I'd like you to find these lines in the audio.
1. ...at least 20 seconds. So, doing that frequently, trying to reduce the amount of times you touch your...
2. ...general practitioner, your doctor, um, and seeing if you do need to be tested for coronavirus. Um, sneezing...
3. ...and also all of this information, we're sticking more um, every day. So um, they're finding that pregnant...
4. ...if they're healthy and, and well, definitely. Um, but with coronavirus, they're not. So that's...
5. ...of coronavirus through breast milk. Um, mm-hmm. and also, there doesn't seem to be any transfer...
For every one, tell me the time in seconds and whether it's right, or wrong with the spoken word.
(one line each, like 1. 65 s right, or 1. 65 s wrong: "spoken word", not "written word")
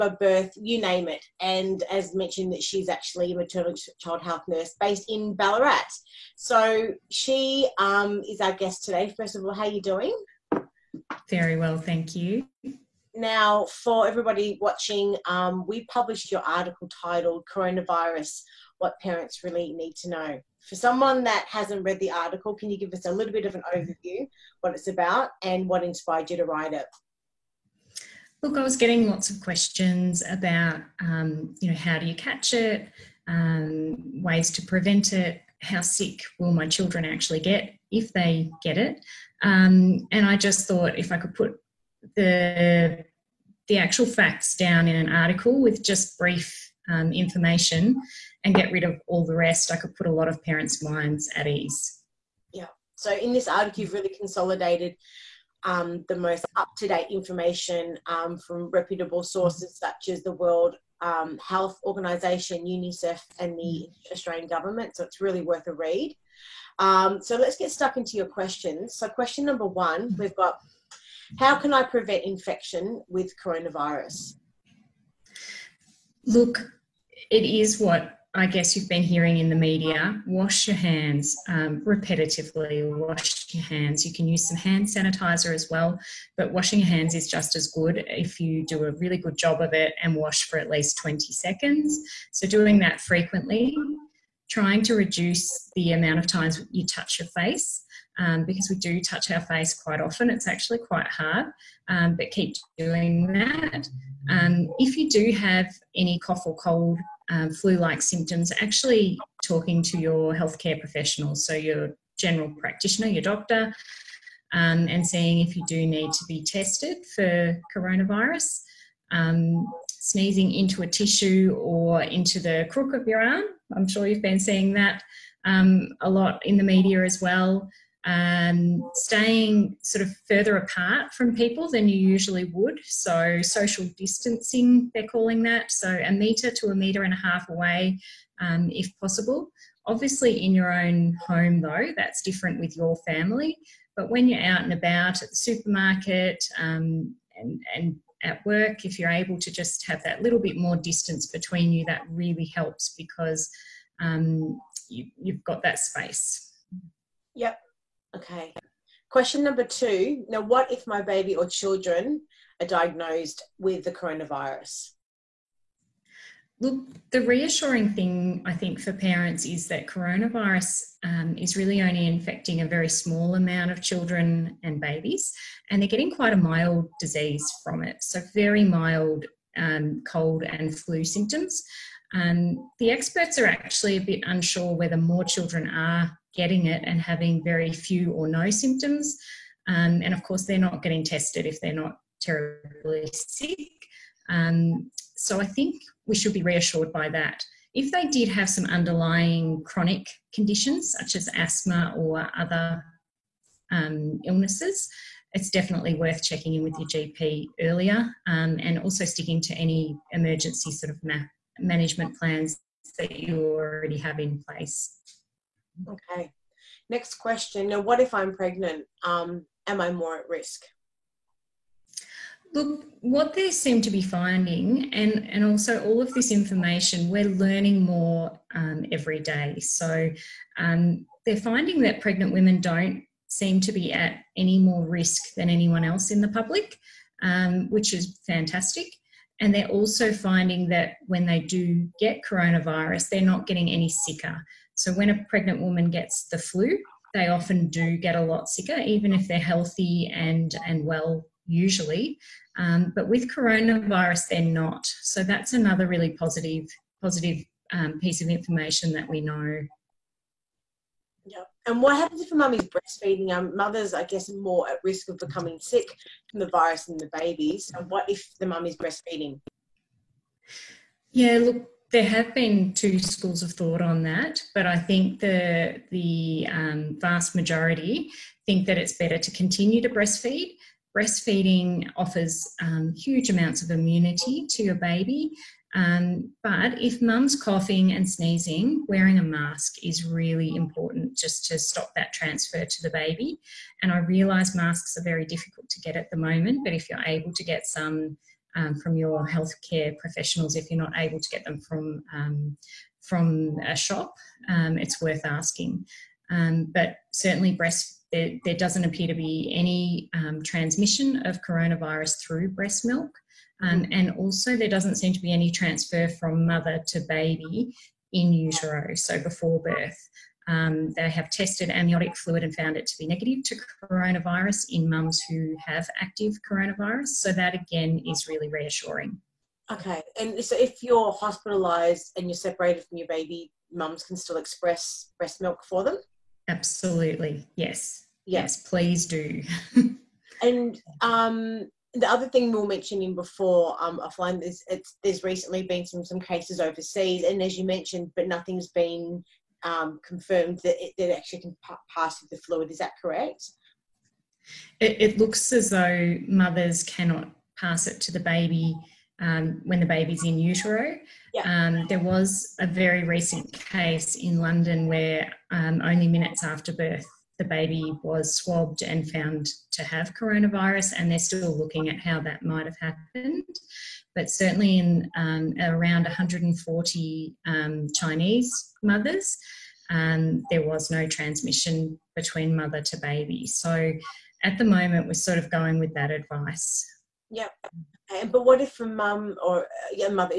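1. 90 s right
2. 112 s right
3. 225 s wrong: "learning", not "sticking"
4. 249 s wrong: "usually", not "definitely"
5. 311 s right.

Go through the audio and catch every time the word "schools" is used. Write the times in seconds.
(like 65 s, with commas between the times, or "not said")
272 s.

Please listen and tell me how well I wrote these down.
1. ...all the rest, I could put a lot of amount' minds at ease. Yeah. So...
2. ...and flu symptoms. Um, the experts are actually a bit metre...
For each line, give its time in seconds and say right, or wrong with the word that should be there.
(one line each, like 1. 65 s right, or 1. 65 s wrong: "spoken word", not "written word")
1. 49 s wrong: "parents", not "amount"
2. 180 s wrong: "unsure", not "metre".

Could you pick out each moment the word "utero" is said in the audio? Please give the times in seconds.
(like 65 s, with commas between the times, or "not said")
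318 s, 360 s.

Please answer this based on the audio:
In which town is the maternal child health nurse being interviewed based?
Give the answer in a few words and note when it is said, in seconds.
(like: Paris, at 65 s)
Ballarat, at 5 s.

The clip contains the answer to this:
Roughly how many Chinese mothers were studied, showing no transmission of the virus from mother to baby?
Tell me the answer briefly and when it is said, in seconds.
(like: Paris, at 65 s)
140, at 376 s.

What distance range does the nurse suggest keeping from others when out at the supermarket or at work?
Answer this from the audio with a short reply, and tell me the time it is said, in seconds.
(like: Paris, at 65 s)
1 to 1.5 metres, at 136 s.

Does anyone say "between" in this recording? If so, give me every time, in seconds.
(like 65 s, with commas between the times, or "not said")
151 s, 382 s.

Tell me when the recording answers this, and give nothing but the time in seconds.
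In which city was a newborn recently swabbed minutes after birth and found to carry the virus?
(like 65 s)
364 s.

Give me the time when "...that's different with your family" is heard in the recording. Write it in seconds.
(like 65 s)
141 s.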